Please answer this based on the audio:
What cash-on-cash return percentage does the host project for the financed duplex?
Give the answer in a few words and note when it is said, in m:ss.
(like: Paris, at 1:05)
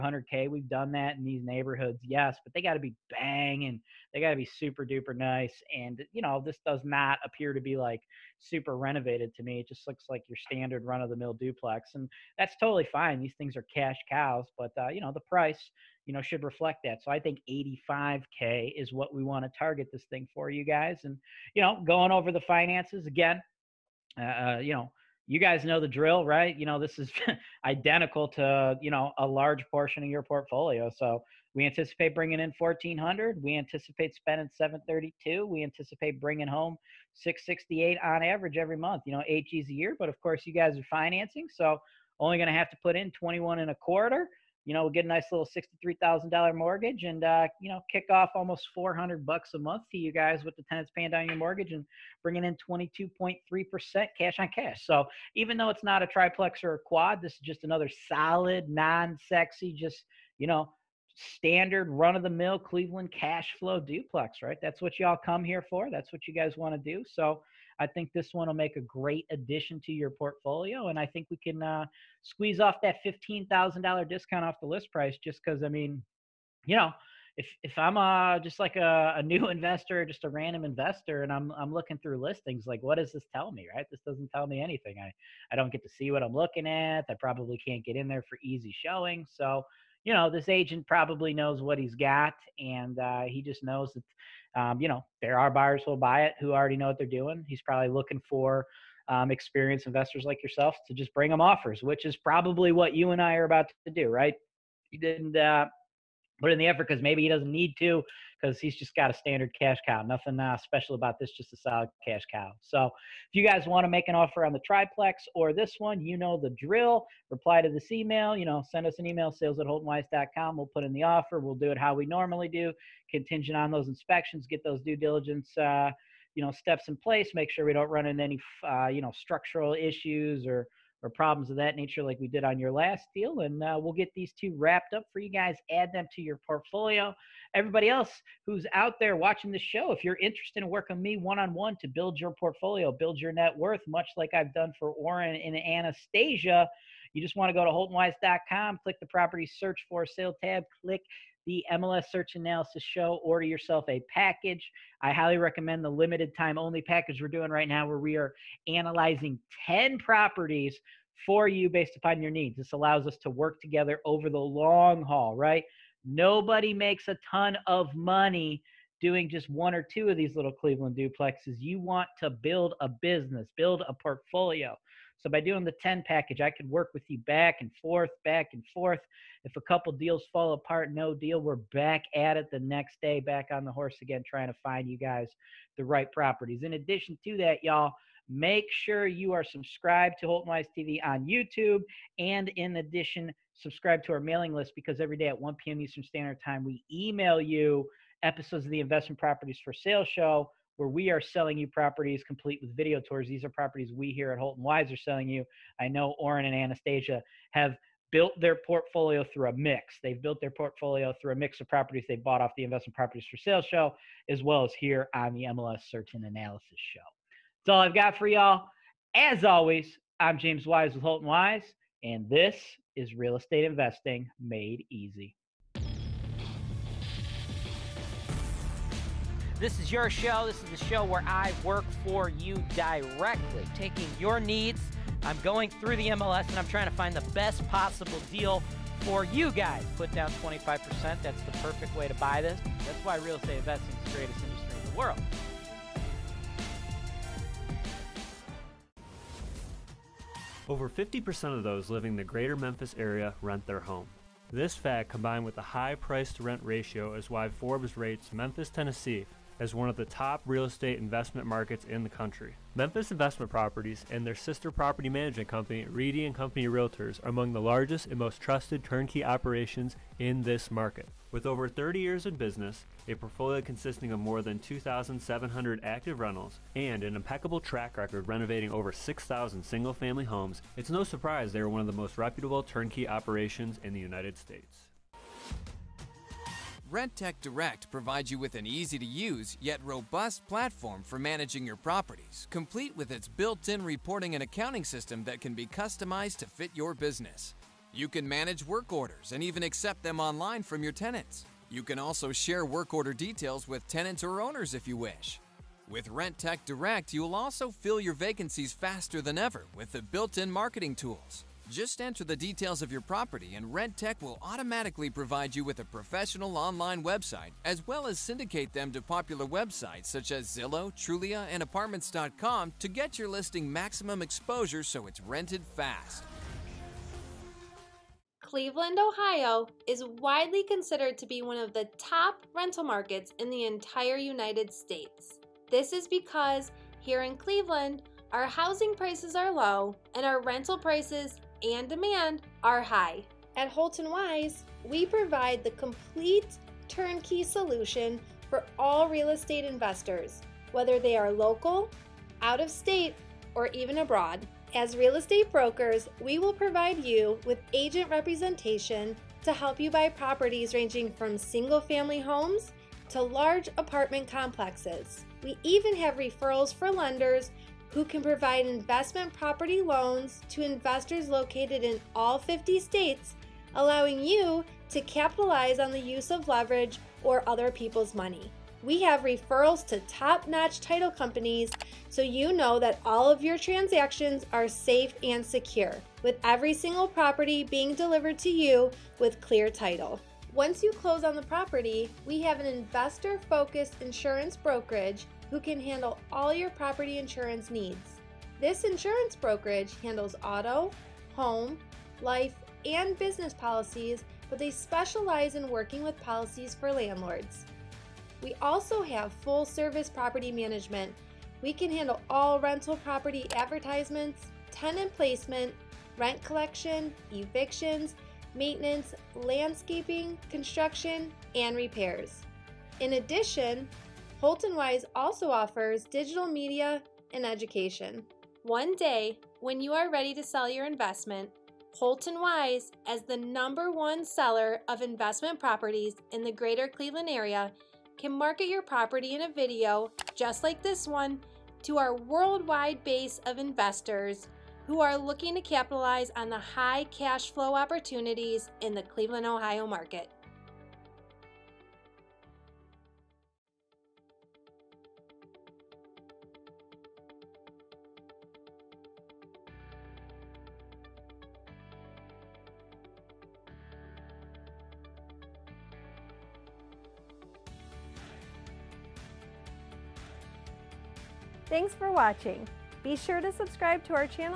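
22.3%, at 0:52.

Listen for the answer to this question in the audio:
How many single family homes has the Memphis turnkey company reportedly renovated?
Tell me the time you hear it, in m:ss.
4:38.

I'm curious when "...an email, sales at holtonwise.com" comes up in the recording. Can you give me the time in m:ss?
1:58.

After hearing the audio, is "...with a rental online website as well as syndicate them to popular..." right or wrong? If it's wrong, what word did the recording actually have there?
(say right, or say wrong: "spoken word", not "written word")
wrong: "professional", not "rental".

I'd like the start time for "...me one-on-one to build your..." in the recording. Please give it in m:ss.
2:21.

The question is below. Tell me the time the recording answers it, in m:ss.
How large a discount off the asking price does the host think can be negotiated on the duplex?
1:13.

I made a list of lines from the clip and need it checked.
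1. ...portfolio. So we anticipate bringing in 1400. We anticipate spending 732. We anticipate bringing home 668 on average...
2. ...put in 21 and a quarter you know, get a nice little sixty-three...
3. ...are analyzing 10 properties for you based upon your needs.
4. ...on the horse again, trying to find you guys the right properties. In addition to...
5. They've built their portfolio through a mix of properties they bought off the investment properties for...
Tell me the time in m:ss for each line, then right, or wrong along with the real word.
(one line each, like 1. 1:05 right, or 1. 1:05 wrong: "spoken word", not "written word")
1. 0:30 right
2. 0:42 right
3. 2:38 right
4. 3:03 right
5. 3:30 right.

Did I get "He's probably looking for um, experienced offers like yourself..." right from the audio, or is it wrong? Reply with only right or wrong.
wrong.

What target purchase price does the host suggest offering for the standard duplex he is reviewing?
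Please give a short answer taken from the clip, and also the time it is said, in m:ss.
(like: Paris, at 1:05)
85K, at 0:17.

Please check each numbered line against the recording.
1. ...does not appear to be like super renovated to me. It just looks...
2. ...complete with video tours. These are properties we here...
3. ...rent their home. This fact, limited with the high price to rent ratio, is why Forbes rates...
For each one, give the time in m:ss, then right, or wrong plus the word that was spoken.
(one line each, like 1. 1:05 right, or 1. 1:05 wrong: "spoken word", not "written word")
1. 0:06 right
2. 3:22 right
3. 4:13 wrong: "combined", not "limited".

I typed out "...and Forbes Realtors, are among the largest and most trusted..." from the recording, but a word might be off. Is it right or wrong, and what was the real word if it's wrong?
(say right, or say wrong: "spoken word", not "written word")
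wrong: "Company", not "Forbes".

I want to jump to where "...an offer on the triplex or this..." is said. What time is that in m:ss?
1:54.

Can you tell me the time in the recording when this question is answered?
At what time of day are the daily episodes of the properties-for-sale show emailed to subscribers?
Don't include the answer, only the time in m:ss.
3:15.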